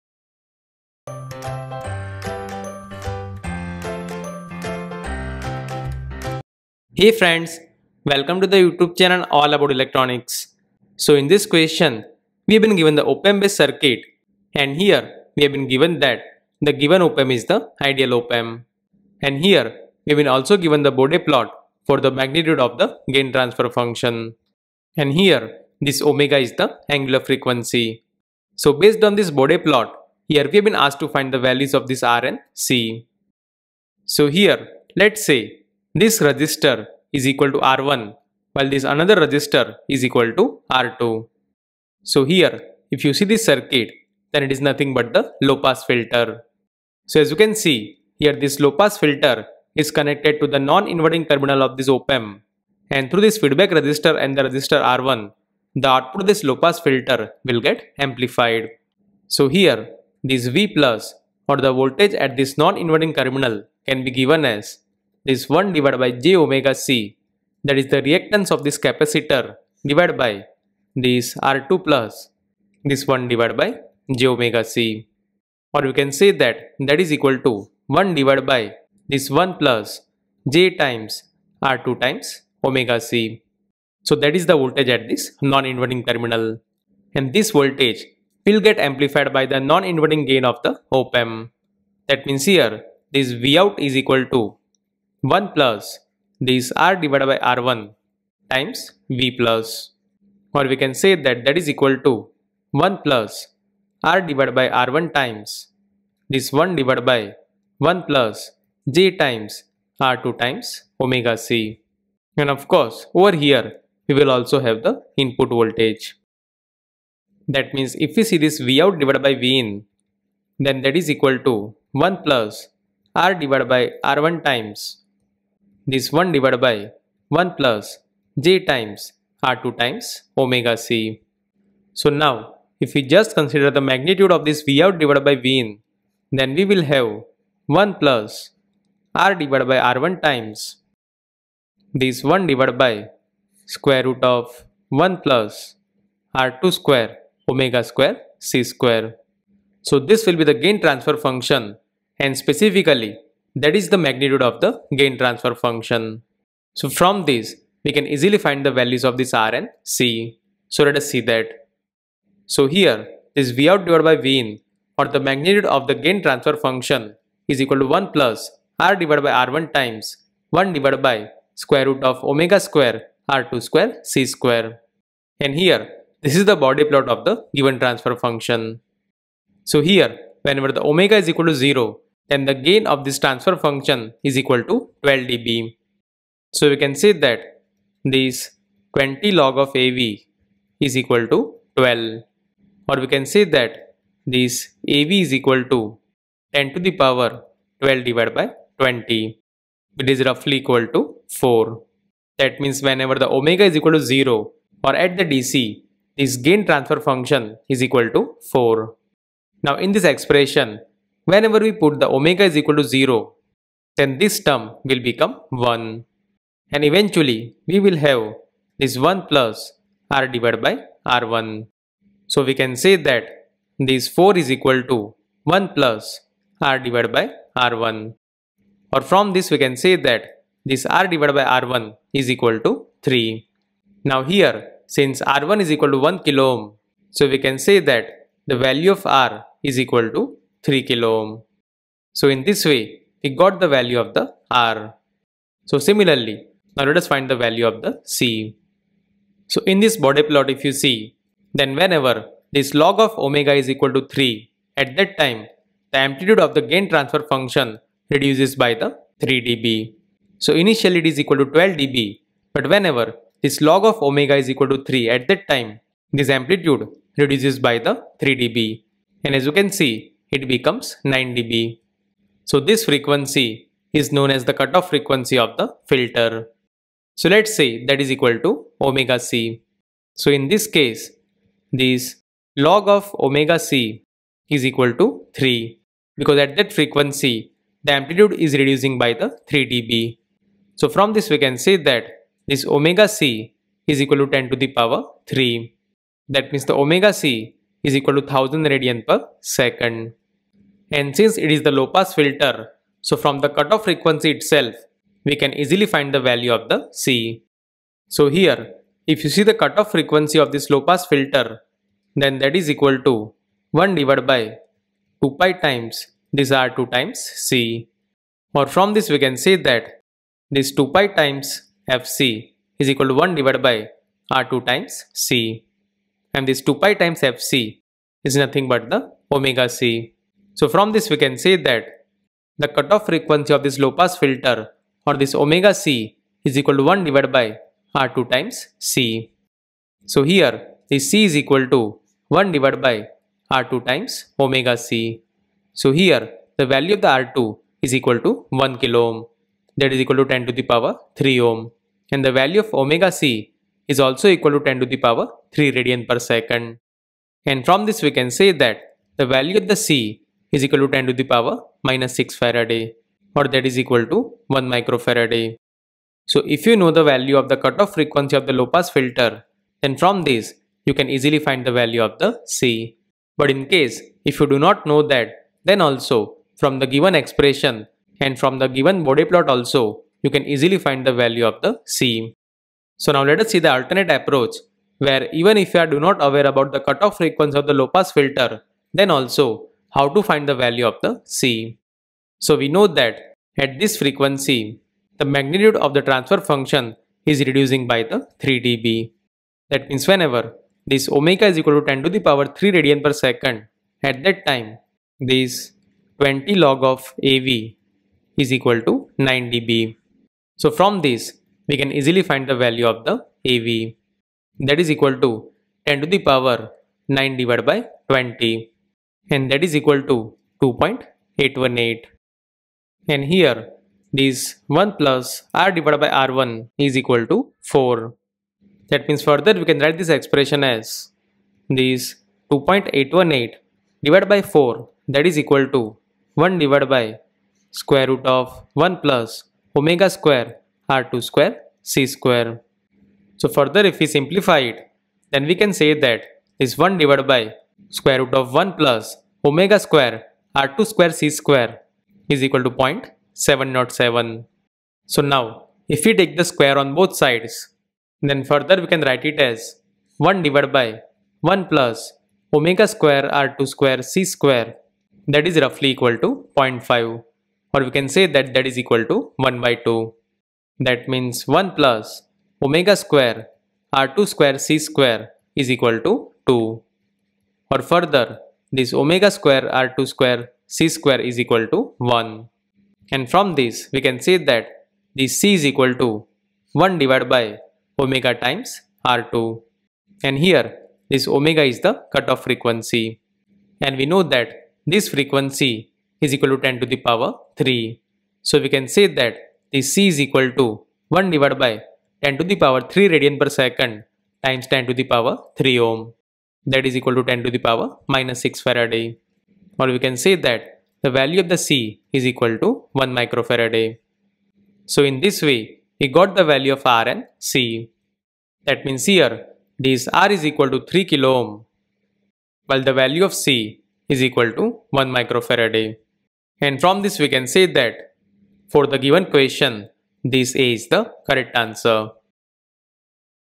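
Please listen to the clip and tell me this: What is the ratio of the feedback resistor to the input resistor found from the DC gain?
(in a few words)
3.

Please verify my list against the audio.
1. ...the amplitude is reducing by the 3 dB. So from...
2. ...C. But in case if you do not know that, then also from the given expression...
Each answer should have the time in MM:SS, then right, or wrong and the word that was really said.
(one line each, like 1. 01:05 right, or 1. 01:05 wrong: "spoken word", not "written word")
1. 04:47 right
2. 06:12 right.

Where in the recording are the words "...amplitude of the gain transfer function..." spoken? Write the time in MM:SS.
04:15.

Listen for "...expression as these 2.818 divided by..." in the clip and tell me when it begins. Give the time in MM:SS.
07:10.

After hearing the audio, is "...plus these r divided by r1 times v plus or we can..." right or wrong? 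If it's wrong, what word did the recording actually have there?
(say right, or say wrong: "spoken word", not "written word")
right.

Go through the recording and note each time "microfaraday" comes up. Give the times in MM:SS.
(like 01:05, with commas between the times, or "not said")
06:04, 08:33, 08:45.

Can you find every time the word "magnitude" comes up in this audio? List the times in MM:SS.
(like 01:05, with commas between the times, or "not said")
00:22, 02:13, 02:33, 02:45, 06:35.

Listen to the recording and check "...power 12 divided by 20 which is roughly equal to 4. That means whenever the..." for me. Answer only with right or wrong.
right.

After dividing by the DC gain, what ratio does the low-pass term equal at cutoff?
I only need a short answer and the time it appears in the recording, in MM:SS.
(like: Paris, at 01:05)
0.707, at 07:32.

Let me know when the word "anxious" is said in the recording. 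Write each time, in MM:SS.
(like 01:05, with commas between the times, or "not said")
not said.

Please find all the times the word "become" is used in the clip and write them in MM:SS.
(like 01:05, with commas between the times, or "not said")
03:34, 04:30.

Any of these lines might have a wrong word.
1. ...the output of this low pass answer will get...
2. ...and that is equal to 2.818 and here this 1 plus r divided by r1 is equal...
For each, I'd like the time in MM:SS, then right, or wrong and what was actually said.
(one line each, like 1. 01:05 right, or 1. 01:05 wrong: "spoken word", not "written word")
1. 00:55 wrong: "filter", not "answer"
2. 06:59 right.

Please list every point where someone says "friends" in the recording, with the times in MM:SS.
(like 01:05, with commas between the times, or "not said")
00:07.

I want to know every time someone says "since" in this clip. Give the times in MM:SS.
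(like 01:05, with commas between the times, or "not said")
03:54, 05:01.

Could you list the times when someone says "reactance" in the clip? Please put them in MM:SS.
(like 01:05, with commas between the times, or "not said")
01:08.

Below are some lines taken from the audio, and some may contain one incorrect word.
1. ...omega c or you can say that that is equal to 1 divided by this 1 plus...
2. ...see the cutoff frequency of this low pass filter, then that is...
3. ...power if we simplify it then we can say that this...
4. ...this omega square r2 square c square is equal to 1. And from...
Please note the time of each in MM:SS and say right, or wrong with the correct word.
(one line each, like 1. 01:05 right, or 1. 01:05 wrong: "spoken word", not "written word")
1. 01:14 right
2. 05:09 right
3. 07:23 wrong: "further", not "power"
4. 07:58 right.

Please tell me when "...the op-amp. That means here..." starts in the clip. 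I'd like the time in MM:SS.
01:30.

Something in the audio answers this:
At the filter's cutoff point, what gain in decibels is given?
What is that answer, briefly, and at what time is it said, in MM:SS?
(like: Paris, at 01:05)
9 dB, at 04:30.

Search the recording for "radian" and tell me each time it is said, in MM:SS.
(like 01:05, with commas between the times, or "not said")
04:58, 05:55, 06:42, 08:23.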